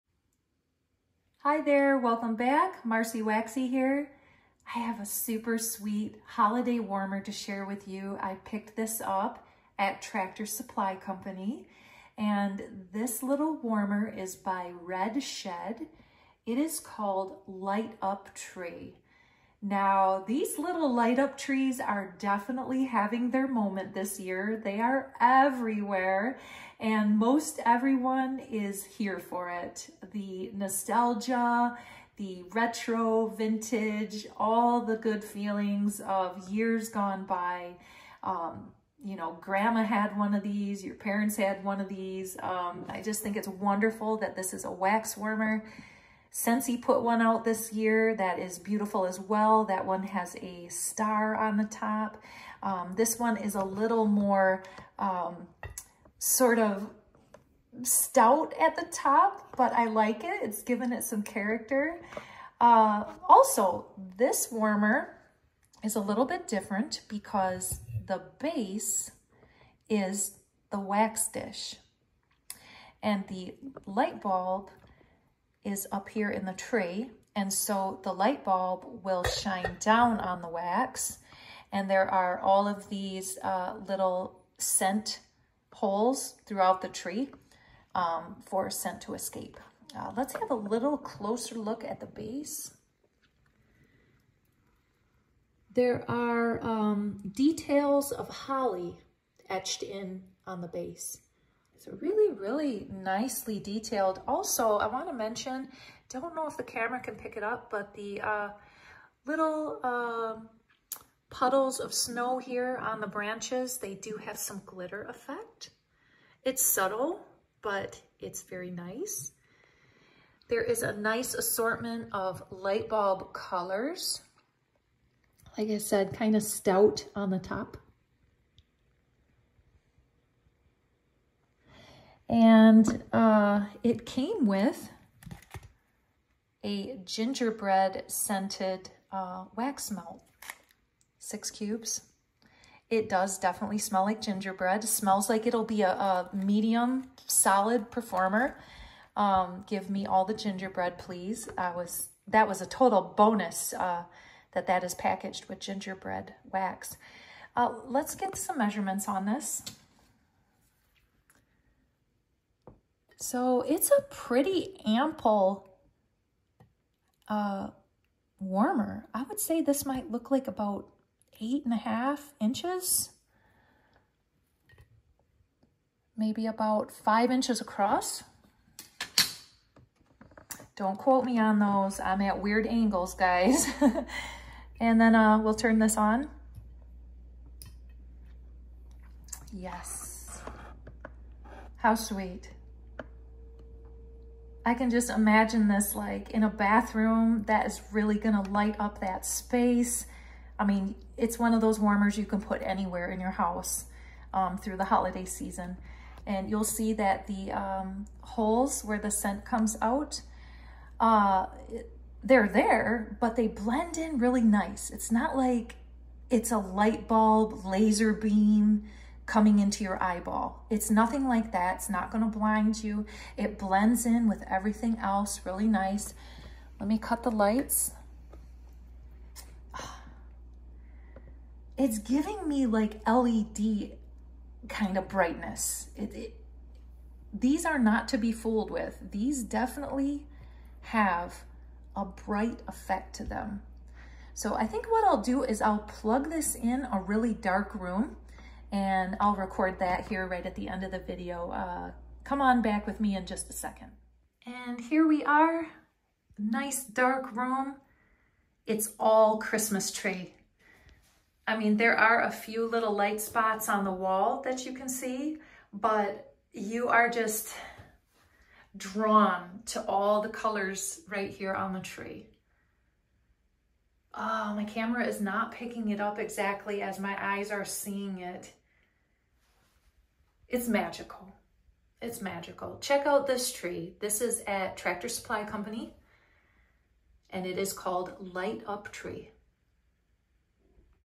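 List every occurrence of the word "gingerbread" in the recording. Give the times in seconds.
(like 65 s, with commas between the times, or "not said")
137 s, 144 s, 150 s, 155 s.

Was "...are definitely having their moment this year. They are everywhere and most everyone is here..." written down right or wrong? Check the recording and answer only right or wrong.
right.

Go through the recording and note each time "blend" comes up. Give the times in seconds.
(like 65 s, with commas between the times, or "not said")
213 s, 223 s.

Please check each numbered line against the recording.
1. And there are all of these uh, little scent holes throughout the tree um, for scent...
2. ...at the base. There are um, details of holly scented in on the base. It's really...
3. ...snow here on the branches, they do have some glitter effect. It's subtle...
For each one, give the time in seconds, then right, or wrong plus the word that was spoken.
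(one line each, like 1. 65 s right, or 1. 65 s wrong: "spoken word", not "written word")
1. 81 s right
2. 91 s wrong: "etched", not "scented"
3. 111 s right.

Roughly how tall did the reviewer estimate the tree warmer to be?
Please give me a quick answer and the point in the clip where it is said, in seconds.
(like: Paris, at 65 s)
8.5 inches, at 171 s.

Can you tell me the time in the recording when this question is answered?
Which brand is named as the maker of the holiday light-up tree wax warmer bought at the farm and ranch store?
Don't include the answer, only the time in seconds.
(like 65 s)
14 s.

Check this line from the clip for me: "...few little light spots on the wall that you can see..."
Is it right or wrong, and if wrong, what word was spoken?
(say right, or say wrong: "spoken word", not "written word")
right.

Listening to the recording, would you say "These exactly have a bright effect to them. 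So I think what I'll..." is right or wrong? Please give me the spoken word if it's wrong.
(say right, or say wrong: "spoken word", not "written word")
wrong: "definitely", not "exactly".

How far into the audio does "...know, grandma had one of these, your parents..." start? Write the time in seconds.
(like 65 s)
39 s.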